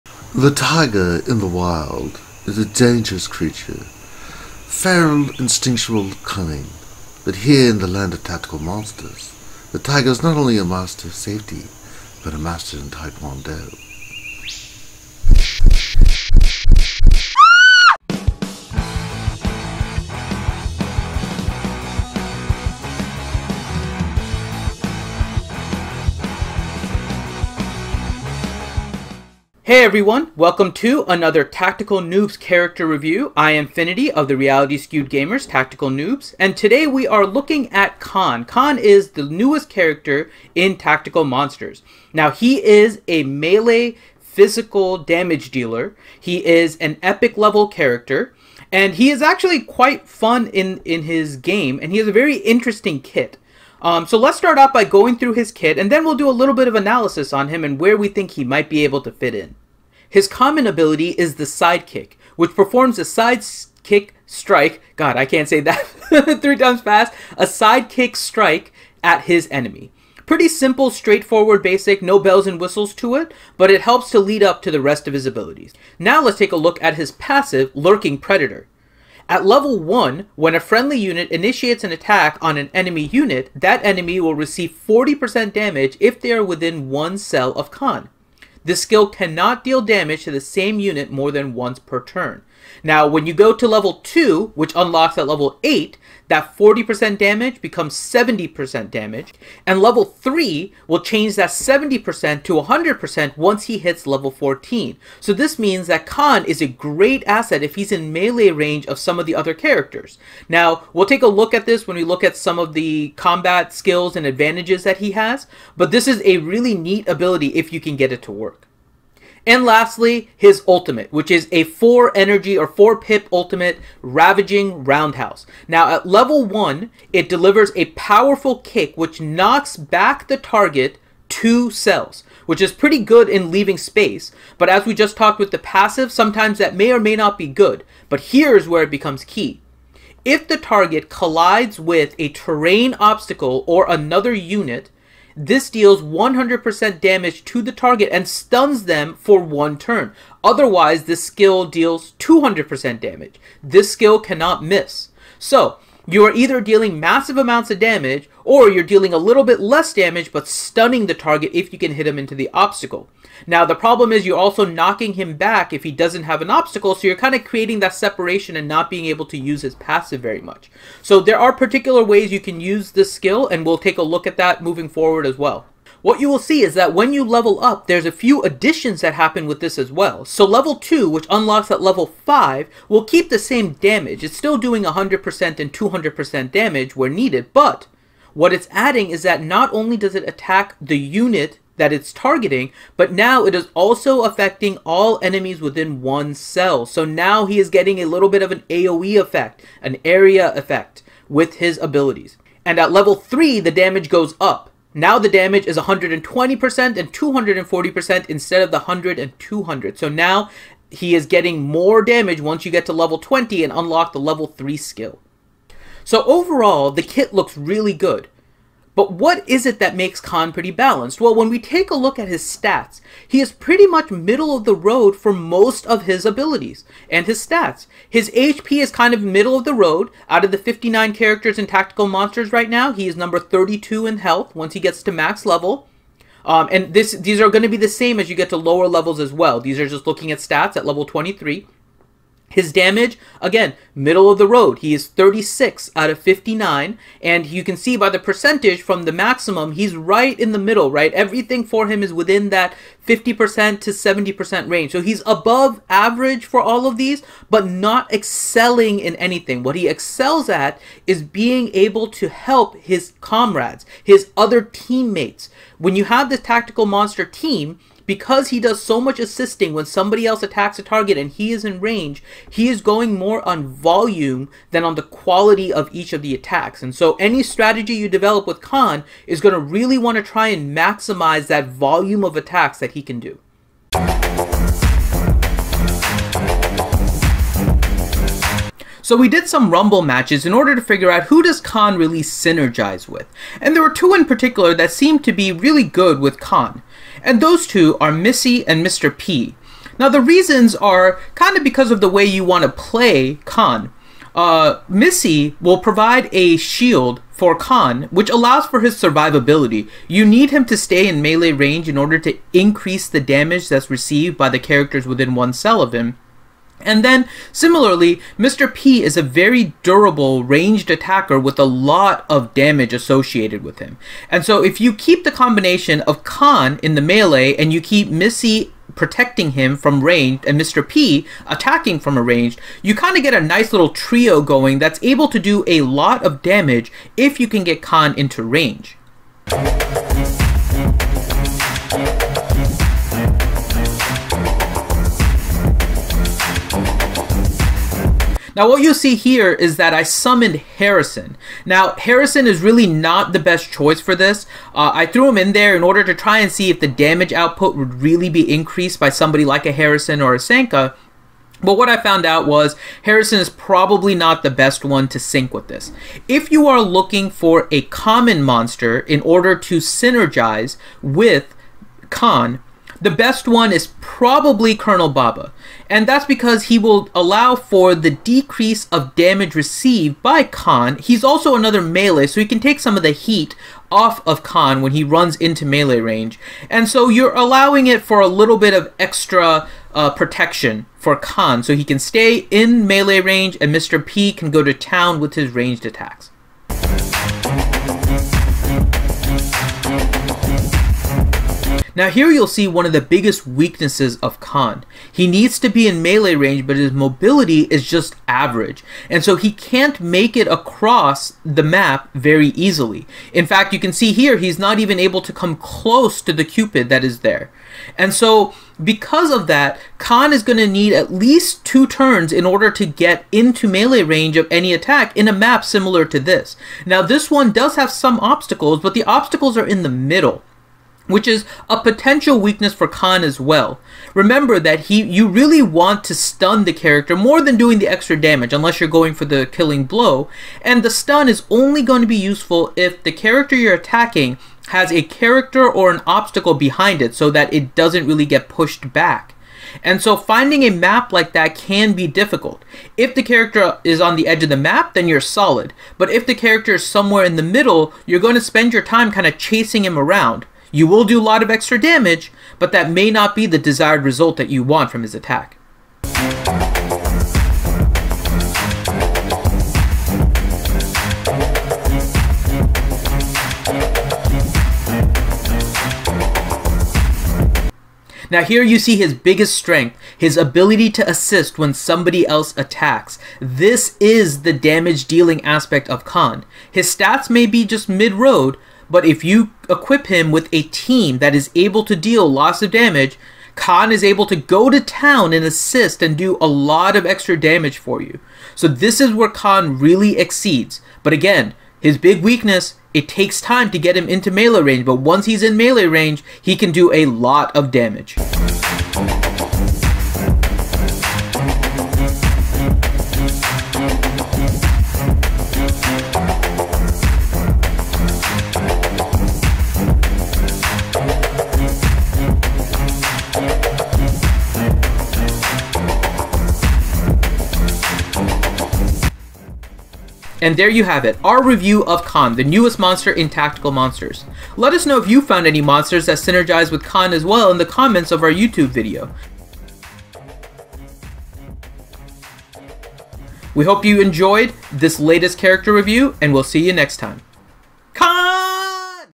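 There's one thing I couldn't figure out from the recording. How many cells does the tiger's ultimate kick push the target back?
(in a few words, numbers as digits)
2.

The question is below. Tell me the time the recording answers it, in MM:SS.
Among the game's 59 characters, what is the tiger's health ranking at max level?
03:53.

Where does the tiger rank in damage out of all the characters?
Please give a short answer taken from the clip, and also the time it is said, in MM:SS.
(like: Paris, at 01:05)
36, at 04:05.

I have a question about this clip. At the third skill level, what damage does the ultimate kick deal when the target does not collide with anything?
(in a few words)
240%.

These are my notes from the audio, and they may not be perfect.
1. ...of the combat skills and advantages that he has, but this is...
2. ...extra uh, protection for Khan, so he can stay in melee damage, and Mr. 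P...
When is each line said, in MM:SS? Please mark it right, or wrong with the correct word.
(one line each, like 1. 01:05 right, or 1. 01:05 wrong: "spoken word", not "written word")
1. 01:52 right
2. 06:28 wrong: "range", not "damage".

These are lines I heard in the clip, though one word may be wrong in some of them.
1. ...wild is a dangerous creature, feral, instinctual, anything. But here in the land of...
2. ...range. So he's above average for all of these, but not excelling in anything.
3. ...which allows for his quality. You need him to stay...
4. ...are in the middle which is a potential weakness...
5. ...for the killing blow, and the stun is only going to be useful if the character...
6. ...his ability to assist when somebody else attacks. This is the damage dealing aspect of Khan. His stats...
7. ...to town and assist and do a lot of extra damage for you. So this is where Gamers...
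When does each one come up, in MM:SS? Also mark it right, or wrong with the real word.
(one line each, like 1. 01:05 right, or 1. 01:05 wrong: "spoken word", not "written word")
1. 00:01 wrong: "cunning", not "anything"
2. 04:14 right
3. 05:08 wrong: "survivability", not "quality"
4. 07:09 right
5. 07:19 right
6. 08:00 right
7. 08:14 wrong: "Khan", not "Gamers".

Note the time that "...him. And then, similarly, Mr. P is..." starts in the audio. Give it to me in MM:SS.
05:15.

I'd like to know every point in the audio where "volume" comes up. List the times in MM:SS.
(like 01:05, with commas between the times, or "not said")
04:33, 04:41.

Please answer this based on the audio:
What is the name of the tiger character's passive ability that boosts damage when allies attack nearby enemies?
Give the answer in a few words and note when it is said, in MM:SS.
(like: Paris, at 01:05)
Lurking Predator, at 01:17.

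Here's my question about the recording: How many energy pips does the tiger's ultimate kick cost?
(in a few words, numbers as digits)
4.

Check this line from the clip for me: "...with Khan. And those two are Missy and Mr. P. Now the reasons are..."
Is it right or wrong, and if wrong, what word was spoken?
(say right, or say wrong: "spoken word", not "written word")
right.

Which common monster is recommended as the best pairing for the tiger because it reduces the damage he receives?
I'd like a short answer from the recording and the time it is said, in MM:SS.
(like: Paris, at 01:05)
Colonel Baba, at 06:14.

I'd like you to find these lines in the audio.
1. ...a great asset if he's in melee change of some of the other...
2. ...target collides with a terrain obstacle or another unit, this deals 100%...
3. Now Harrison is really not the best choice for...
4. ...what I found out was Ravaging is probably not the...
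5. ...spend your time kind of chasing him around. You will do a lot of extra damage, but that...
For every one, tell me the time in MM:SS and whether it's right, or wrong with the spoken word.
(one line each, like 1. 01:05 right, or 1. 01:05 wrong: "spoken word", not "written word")
1. 01:46 wrong: "range", not "change"
2. 02:20 right
3. 05:51 right
4. 06:01 wrong: "Harrison", not "Ravaging"
5. 07:38 right.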